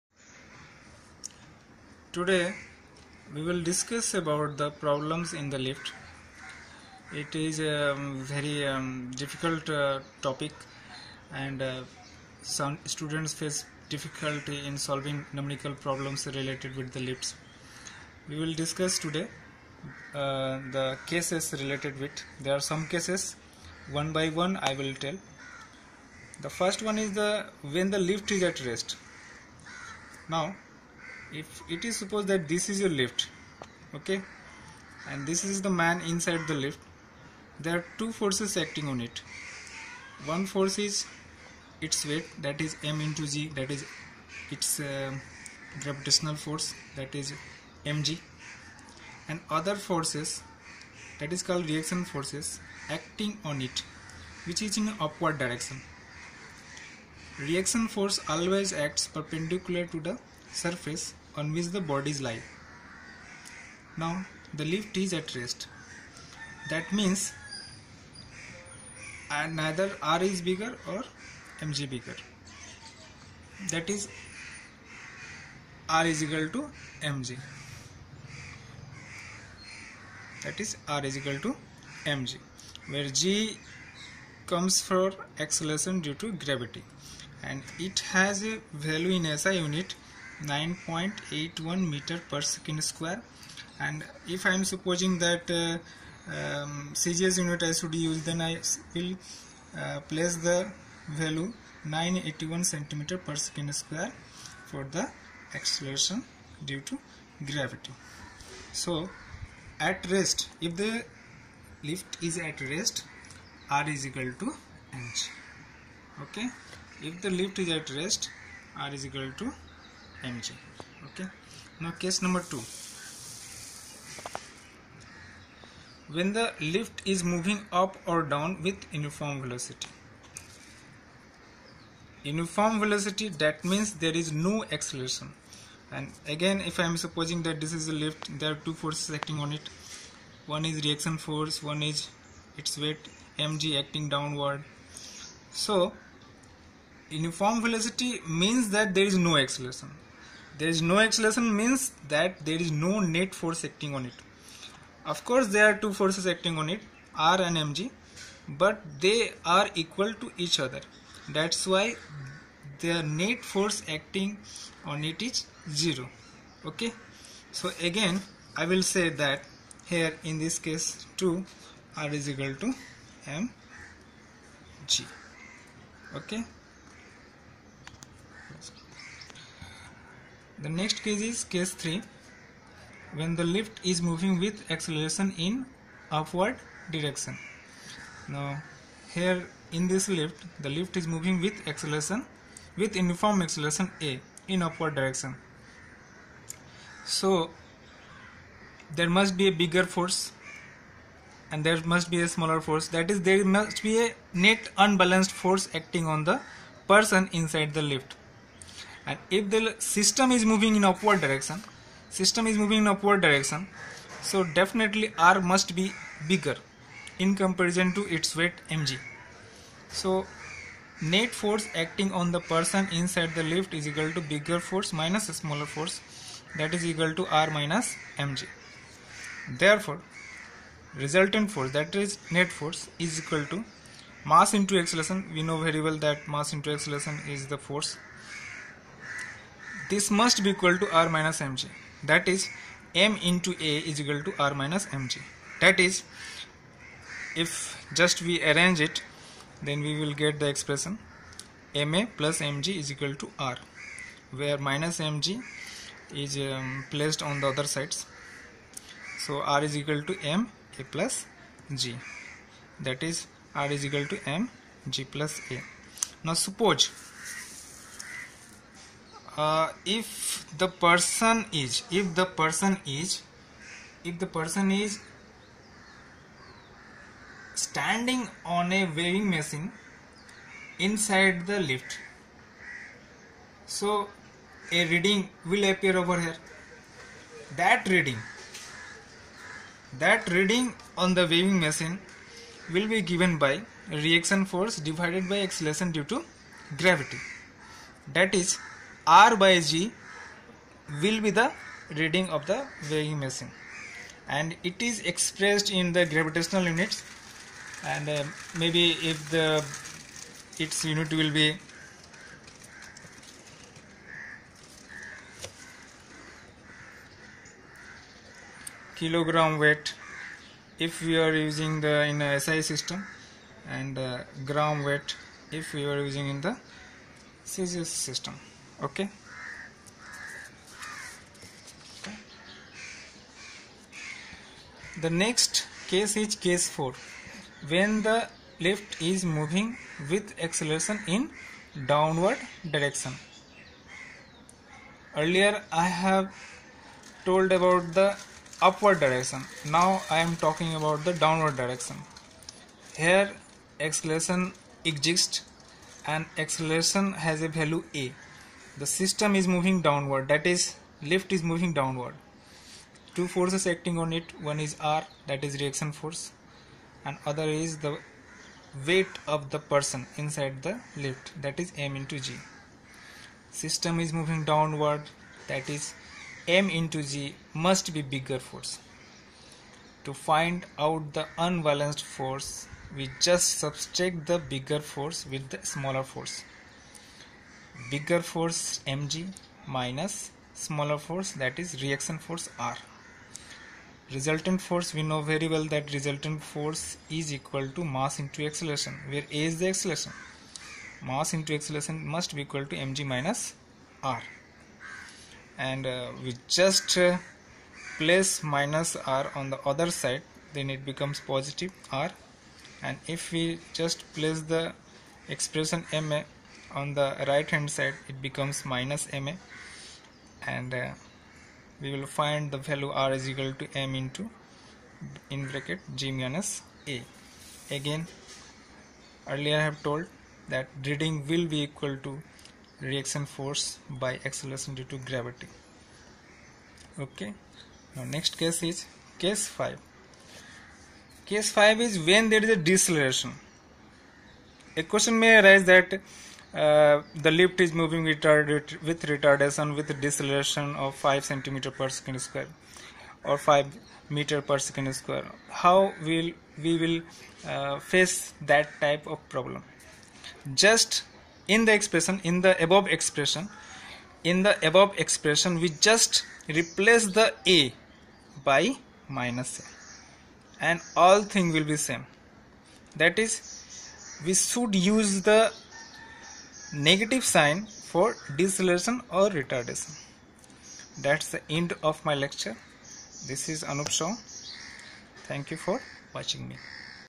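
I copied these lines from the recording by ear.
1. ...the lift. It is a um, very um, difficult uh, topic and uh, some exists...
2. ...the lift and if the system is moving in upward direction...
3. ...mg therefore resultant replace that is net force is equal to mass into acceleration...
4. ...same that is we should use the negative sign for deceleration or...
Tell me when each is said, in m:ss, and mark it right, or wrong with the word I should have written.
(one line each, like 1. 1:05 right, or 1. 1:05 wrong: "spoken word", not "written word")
1. 0:05 wrong: "students", not "exists"
2. 3:27 right
3. 3:48 wrong: "force", not "replace"
4. 7:51 right.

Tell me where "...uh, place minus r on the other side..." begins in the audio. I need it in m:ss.
6:46.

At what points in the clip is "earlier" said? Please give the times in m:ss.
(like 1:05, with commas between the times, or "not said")
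5:45, 7:09.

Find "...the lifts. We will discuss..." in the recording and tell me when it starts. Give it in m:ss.
0:16.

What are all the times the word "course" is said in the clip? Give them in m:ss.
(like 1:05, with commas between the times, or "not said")
2:35.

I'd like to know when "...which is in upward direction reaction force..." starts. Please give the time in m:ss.
0:54.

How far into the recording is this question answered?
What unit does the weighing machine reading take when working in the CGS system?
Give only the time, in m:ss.
5:24.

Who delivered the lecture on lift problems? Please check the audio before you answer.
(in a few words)
Anup Shaw.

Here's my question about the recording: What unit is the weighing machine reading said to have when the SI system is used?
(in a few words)
kilogram weight.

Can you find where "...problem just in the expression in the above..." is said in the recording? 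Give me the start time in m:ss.
7:39.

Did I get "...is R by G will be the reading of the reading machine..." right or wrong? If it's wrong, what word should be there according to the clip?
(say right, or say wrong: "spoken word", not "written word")
wrong: "weighing", not "reading".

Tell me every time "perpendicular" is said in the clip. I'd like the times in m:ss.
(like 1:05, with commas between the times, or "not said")
0:59.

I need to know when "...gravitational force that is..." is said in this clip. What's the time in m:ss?
0:45.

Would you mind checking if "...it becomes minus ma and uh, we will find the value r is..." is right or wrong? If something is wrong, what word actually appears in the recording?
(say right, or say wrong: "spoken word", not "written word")
right.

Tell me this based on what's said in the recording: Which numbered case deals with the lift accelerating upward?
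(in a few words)
case 3.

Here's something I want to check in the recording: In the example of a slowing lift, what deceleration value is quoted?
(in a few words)
5 m/s².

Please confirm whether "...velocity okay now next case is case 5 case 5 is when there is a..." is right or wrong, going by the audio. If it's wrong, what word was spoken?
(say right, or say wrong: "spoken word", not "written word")
wrong: "gravity", not "velocity".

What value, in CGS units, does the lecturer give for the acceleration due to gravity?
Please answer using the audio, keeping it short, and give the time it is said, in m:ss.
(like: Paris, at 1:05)
981 cm/s², at 1:41.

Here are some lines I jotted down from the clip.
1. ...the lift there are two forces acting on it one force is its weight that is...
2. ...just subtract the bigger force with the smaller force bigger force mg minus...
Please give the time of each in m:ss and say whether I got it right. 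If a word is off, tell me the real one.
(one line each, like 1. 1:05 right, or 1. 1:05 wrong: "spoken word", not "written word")
1. 0:36 right
2. 6:23 right.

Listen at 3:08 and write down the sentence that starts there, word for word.
Now here in this lift the lift is moving with acceleration with uniform acceleration A in upward direction.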